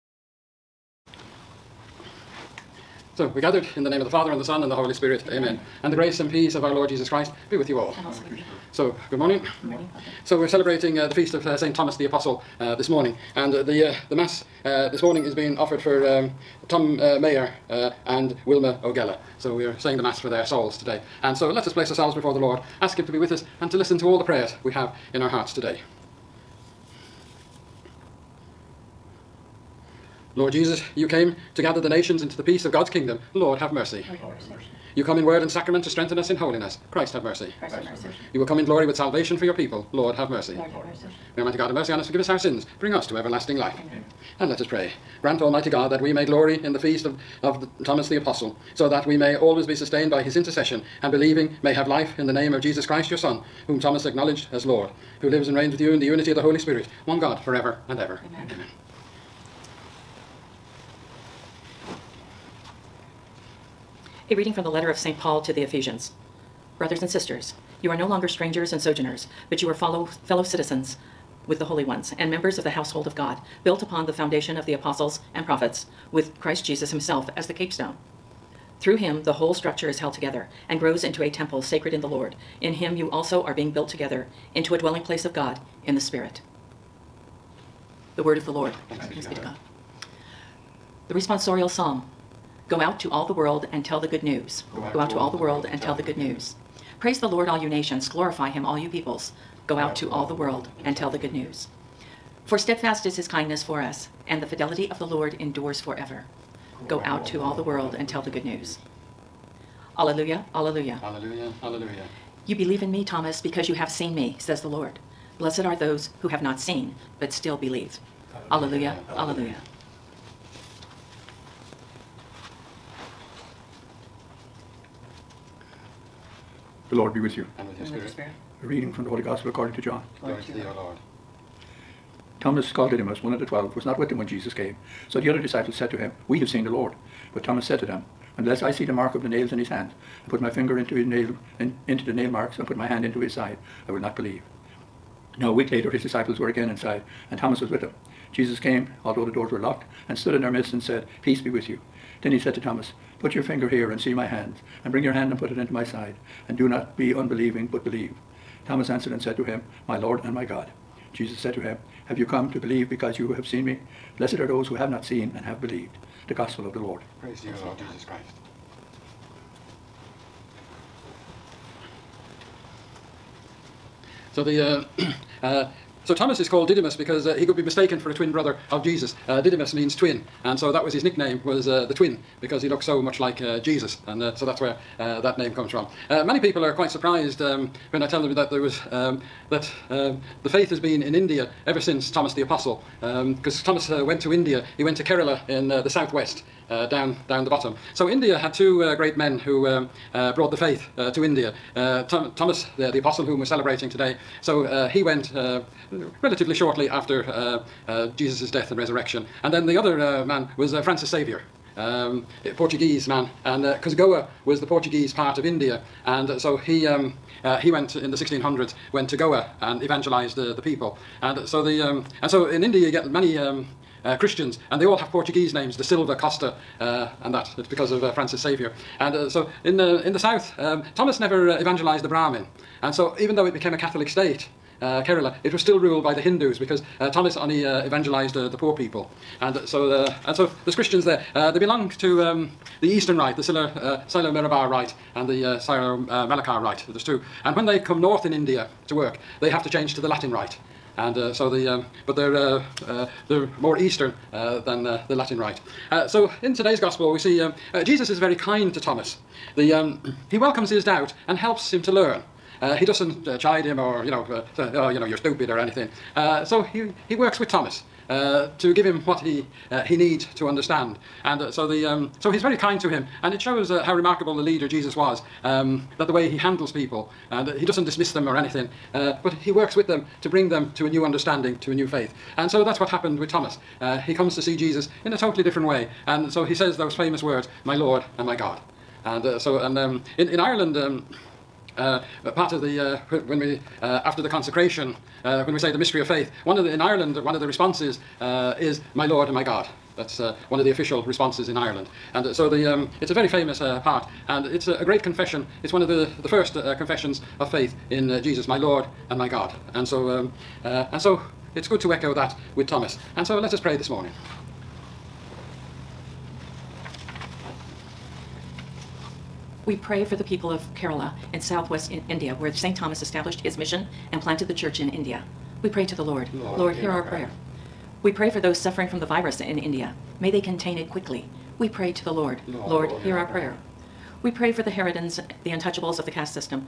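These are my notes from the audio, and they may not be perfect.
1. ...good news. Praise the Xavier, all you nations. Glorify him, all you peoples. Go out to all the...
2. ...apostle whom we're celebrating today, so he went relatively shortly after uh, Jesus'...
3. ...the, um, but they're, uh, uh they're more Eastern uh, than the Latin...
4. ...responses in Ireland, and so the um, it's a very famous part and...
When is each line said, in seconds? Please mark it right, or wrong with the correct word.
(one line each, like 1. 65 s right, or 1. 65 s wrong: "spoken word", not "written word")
1. 96 s wrong: "Lord", not "Xavier"
2. 202 s right
3. 251 s right
4. 301 s right.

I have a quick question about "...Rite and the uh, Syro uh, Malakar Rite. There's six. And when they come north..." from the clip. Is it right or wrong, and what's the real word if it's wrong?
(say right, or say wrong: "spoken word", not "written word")
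wrong: "two", not "six".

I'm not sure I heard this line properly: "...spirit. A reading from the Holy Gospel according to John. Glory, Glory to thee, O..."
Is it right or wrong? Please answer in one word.
right.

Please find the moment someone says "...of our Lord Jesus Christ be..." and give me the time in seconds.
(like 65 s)
6 s.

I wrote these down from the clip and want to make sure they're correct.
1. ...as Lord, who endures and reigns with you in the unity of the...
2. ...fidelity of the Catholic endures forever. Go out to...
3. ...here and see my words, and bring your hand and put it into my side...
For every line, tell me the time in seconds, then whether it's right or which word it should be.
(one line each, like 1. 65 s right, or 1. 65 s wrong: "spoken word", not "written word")
1. 54 s wrong: "lives", not "endures"
2. 104 s wrong: "Lord", not "Catholic"
3. 153 s wrong: "hands", not "words".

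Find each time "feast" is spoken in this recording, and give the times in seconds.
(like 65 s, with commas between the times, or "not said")
11 s, 46 s.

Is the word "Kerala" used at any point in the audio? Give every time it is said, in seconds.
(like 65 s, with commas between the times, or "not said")
195 s, 235 s, 320 s.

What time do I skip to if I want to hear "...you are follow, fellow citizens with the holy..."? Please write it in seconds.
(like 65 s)
69 s.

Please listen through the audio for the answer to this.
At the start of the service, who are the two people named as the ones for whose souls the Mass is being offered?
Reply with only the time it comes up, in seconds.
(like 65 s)
16 s.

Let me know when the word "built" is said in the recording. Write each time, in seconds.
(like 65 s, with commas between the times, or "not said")
73 s, 83 s.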